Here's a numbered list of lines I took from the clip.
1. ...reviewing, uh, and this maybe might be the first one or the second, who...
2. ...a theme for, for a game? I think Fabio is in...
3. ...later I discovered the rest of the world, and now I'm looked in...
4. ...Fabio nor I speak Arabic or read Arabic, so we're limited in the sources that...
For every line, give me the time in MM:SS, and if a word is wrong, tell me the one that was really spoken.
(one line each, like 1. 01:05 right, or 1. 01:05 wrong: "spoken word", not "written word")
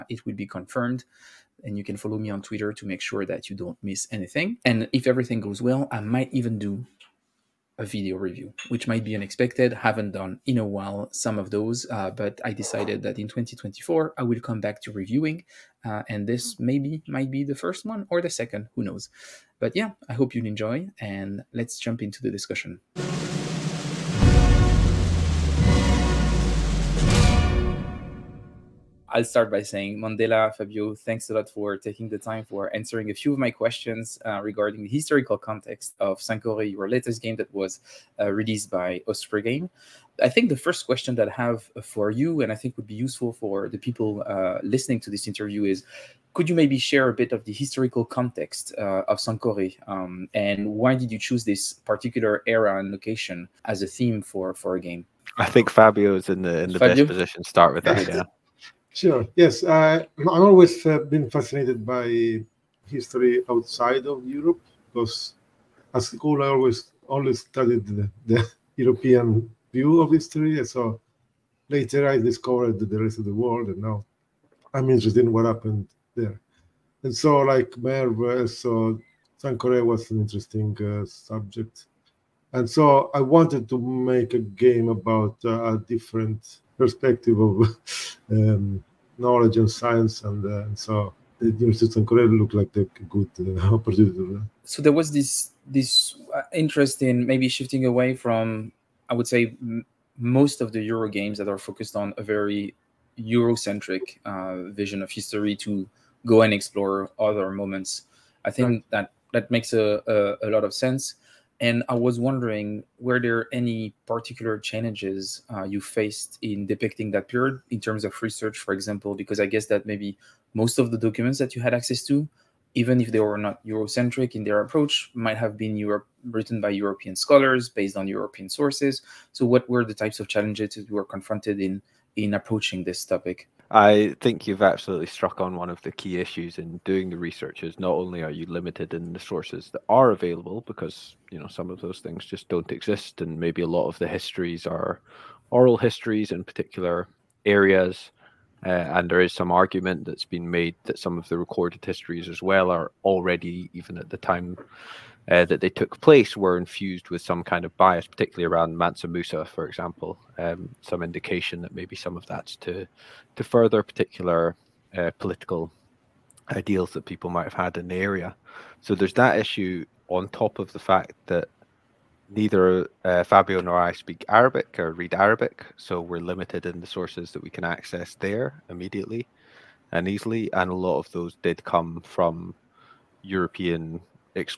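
1. 00:14 right
2. 00:53 right
3. 01:11 wrong: "interested", not "looked"
4. 02:53 right.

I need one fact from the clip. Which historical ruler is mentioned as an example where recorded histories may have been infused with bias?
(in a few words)
Mansa Musa.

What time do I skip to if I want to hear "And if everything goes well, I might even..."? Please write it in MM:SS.
00:04.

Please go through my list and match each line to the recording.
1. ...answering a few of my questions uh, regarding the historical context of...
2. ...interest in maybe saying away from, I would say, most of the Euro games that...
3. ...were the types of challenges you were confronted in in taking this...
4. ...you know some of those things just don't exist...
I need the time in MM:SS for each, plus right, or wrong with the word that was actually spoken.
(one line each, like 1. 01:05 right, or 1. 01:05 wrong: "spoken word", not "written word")
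1. 00:32 right
2. 01:36 wrong: "shifting", not "saying"
3. 02:09 wrong: "approaching", not "taking"
4. 02:21 right.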